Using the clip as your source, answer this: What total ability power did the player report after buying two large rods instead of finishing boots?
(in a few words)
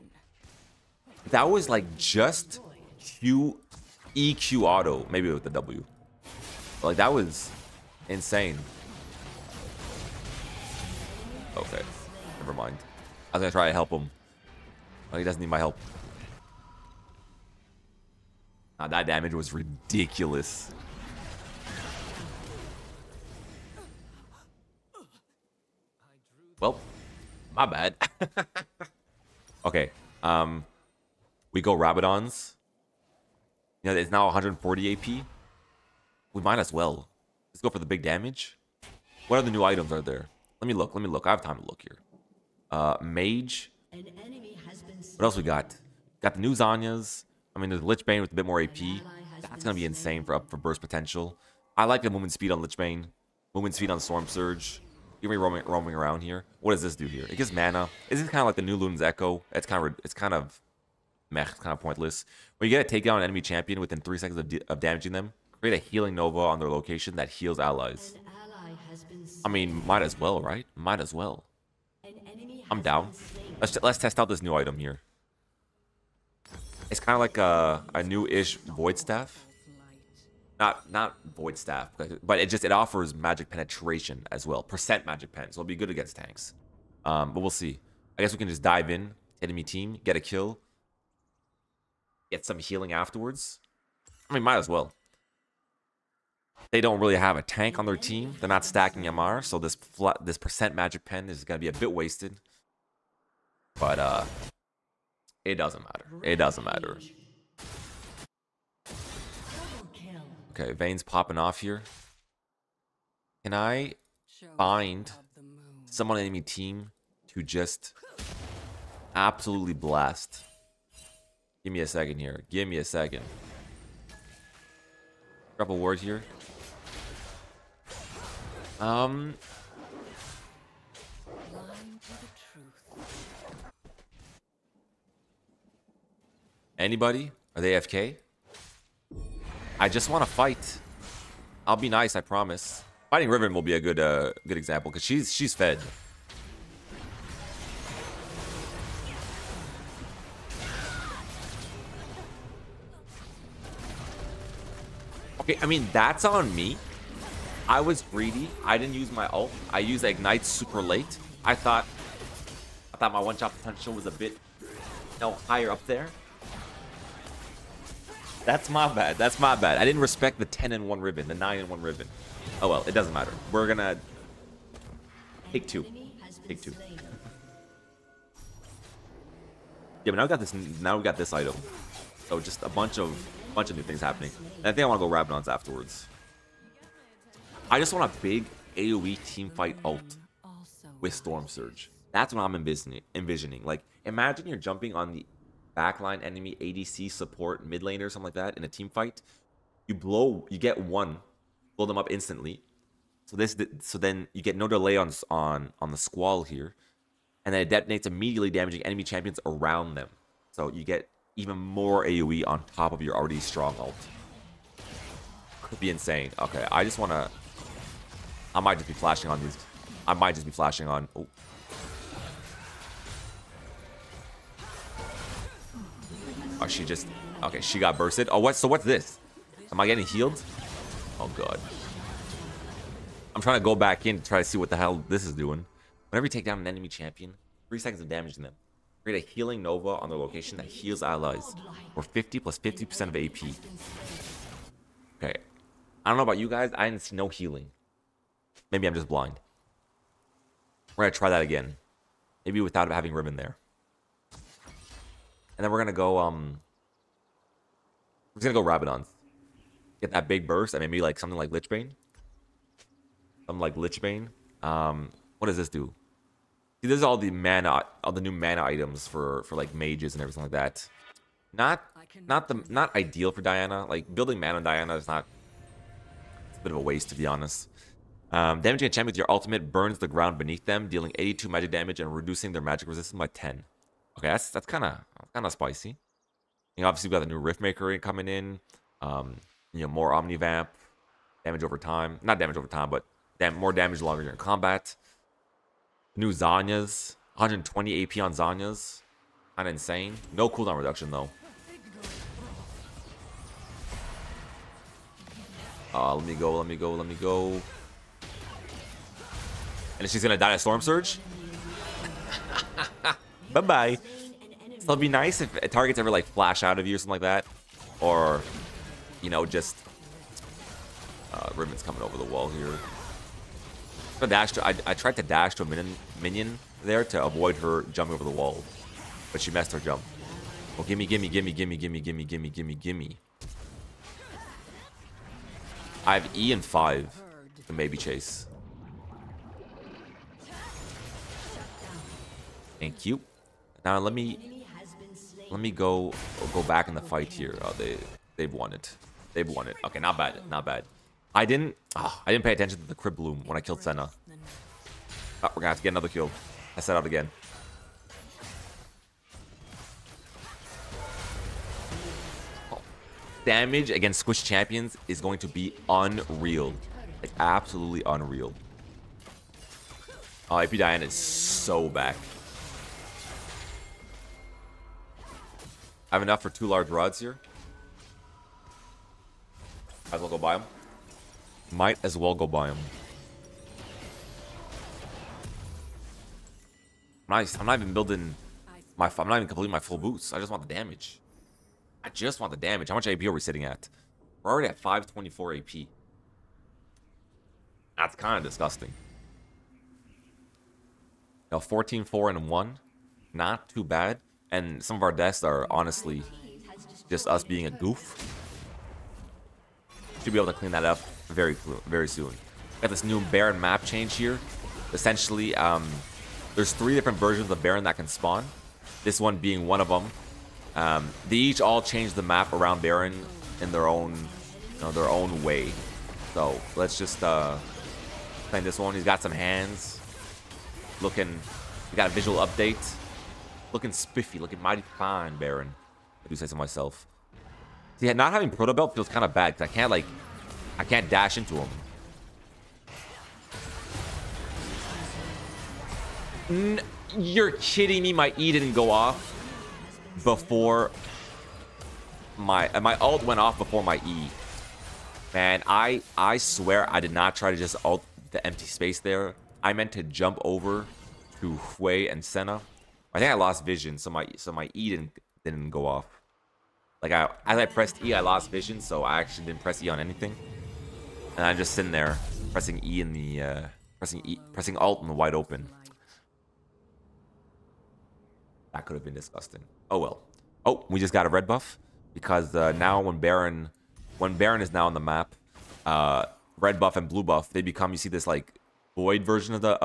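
524.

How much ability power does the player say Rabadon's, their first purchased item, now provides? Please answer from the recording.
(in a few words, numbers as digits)
140 AP.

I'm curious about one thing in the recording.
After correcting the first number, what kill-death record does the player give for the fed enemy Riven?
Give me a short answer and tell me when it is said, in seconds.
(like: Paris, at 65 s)
9 and 1, at 171 s.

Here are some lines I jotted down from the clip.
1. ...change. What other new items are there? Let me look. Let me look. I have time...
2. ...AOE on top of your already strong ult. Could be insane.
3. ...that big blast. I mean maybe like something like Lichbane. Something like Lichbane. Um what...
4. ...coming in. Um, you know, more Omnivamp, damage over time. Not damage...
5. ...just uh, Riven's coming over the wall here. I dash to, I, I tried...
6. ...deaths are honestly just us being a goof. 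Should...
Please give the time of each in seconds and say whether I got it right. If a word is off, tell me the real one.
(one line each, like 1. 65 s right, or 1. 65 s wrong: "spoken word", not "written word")
1. 38 s wrong: "damage", not "change"
2. 212 s right
3. 260 s wrong: "burst", not "blast"
4. 288 s right
5. 319 s right
6. 405 s right.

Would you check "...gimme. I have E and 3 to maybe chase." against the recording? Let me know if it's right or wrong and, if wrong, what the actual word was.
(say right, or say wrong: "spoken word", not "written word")
wrong: "5", not "3".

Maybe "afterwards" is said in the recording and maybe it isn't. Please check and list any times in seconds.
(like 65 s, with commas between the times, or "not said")
92 s, 185 s.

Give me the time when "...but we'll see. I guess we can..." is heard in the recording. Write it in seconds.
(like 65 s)
87 s.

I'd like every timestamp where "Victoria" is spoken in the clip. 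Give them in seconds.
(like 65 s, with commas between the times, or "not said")
not said.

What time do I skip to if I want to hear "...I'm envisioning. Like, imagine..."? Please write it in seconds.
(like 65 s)
192 s.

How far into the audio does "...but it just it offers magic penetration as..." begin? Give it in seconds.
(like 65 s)
82 s.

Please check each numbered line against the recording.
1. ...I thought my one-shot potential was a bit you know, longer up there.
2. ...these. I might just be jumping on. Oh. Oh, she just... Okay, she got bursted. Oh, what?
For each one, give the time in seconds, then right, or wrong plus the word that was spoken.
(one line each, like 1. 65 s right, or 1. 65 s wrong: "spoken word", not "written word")
1. 162 s wrong: "higher", not "longer"
2. 219 s wrong: "flashing", not "jumping".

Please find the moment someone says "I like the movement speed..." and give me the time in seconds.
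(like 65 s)
51 s.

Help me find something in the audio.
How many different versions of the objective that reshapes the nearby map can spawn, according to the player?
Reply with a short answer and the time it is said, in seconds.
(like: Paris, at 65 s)
3, at 416 s.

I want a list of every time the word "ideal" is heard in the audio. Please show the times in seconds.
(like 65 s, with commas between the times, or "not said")
272 s.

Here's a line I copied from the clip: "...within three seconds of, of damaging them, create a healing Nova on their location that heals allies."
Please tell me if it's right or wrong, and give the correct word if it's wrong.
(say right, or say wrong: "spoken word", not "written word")
right.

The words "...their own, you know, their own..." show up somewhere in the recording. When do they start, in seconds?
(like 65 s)
423 s.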